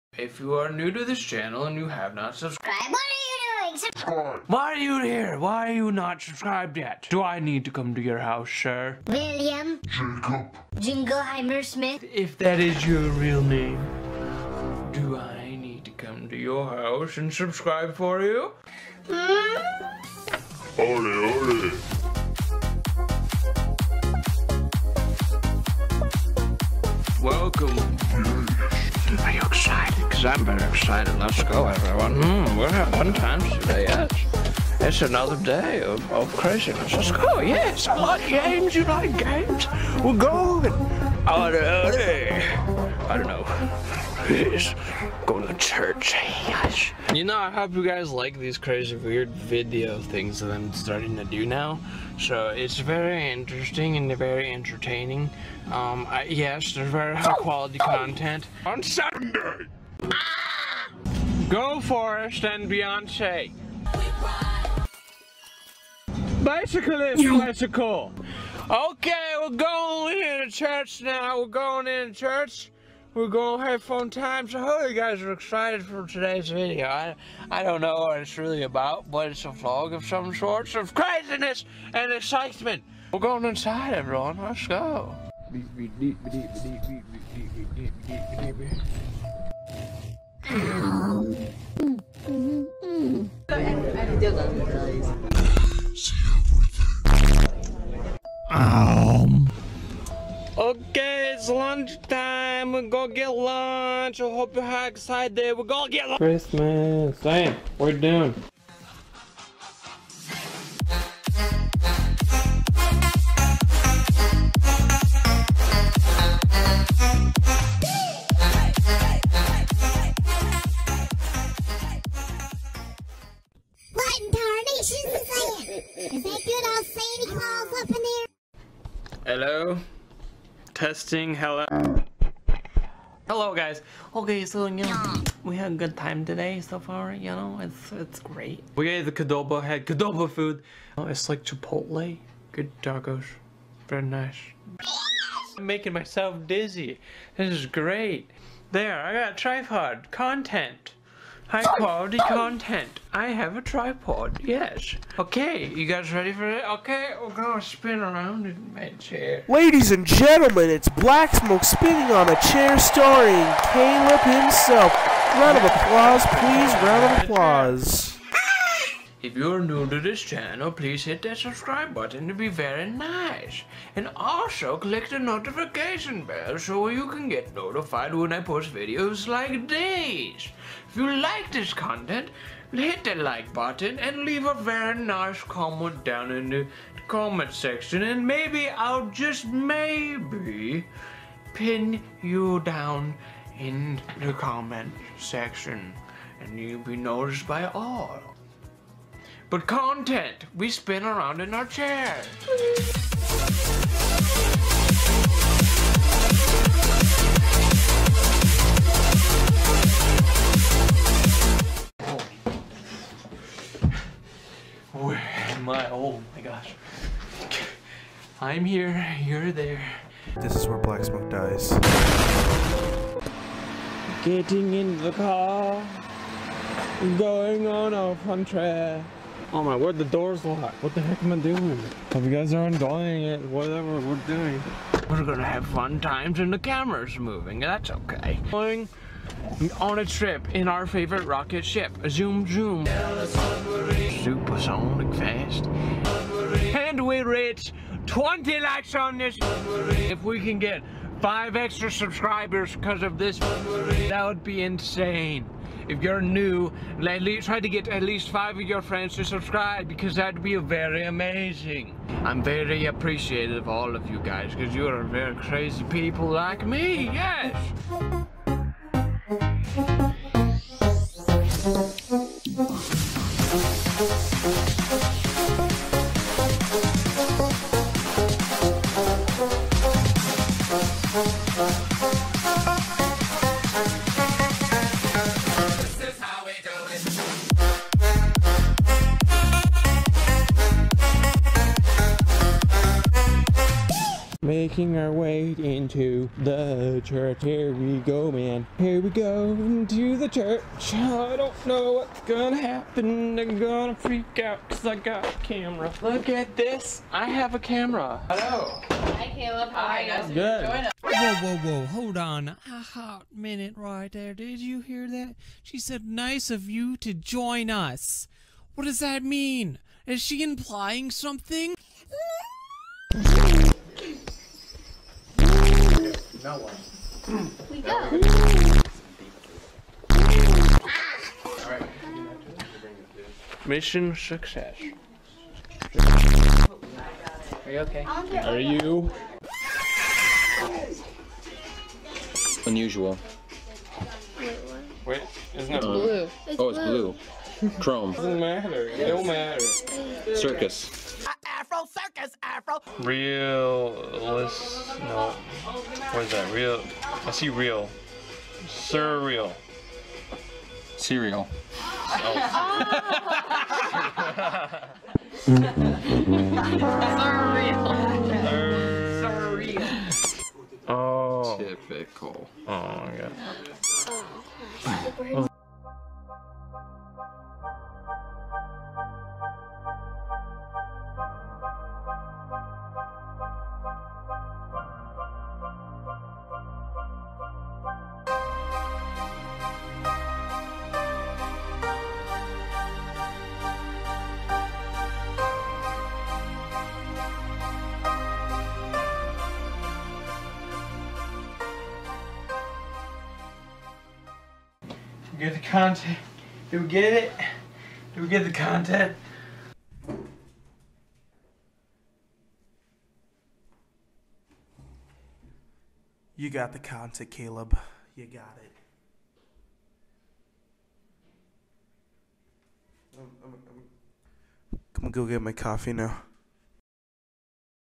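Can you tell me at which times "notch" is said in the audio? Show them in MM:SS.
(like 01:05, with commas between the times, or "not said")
not said.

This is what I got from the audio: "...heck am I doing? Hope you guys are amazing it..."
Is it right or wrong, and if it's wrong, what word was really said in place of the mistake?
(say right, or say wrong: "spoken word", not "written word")
wrong: "enjoying", not "amazing".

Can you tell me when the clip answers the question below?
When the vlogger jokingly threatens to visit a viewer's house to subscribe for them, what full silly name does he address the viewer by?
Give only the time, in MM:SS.
00:09.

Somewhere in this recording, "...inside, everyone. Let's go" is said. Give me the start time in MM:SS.
01:23.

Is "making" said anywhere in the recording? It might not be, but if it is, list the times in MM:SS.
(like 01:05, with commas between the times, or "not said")
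02:25, 04:54.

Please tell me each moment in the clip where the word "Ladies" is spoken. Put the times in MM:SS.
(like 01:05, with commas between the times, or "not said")
02:39.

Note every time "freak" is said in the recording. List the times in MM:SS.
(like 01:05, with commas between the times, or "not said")
05:03.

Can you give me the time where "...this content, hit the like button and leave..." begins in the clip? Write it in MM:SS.
03:01.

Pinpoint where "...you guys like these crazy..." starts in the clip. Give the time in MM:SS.
00:47.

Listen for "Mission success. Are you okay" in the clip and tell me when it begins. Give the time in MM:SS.
05:33.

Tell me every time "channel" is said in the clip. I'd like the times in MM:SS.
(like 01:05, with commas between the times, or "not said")
00:01, 02:50.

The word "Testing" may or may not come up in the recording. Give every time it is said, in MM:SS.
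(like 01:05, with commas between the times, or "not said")
02:10.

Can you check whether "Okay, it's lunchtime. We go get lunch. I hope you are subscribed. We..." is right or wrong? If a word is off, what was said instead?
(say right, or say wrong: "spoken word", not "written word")
wrong: "excited", not "subscribed".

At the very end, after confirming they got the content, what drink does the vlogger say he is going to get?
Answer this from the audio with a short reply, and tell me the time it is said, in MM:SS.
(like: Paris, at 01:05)
Coffee, at 07:05.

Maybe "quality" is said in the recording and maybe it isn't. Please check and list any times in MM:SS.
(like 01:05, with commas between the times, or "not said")
00:57, 02:31.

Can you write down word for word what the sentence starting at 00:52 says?
So it's very interesting and very entertaining.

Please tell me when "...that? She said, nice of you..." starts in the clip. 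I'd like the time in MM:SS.
05:15.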